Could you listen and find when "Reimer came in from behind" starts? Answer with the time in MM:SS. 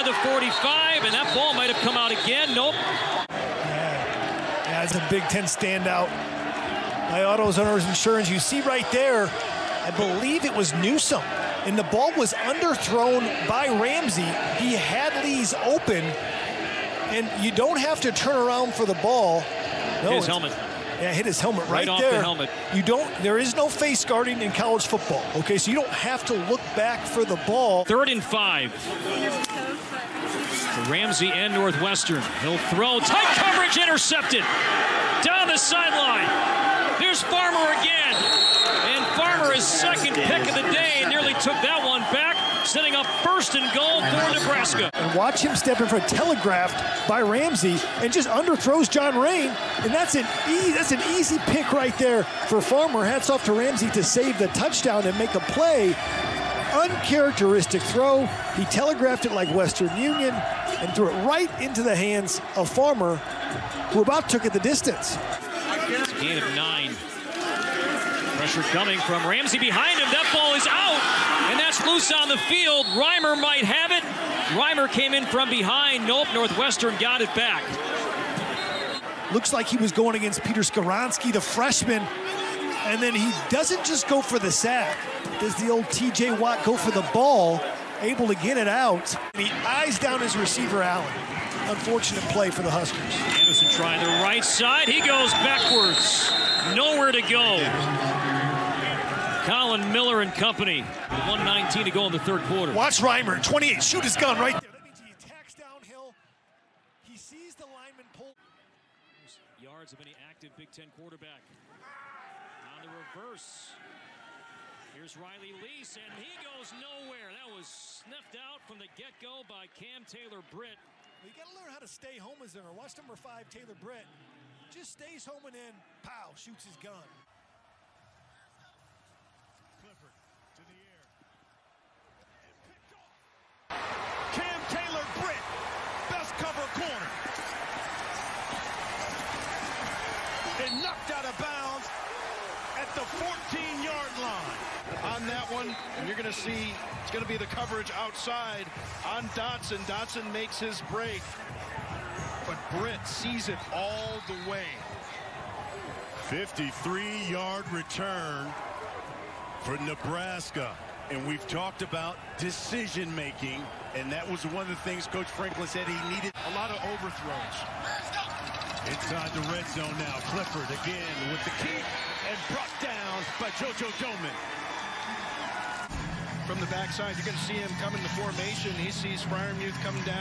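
01:14.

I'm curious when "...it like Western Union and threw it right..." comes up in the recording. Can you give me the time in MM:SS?
00:59.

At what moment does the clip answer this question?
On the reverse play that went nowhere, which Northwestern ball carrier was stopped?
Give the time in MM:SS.
01:55.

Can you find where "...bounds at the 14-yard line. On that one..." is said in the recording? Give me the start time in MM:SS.
02:21.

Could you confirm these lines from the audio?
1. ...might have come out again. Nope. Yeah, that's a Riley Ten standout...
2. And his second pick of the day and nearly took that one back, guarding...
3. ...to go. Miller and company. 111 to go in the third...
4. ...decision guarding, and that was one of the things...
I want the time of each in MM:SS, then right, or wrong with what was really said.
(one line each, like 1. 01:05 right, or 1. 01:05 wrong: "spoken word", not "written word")
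1. 00:01 wrong: "Big", not "Riley"
2. 00:38 wrong: "setting", not "guarding"
3. 01:37 wrong: "119", not "111"
4. 02:42 wrong: "making", not "guarding".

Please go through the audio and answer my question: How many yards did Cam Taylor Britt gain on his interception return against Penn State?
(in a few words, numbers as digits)
53.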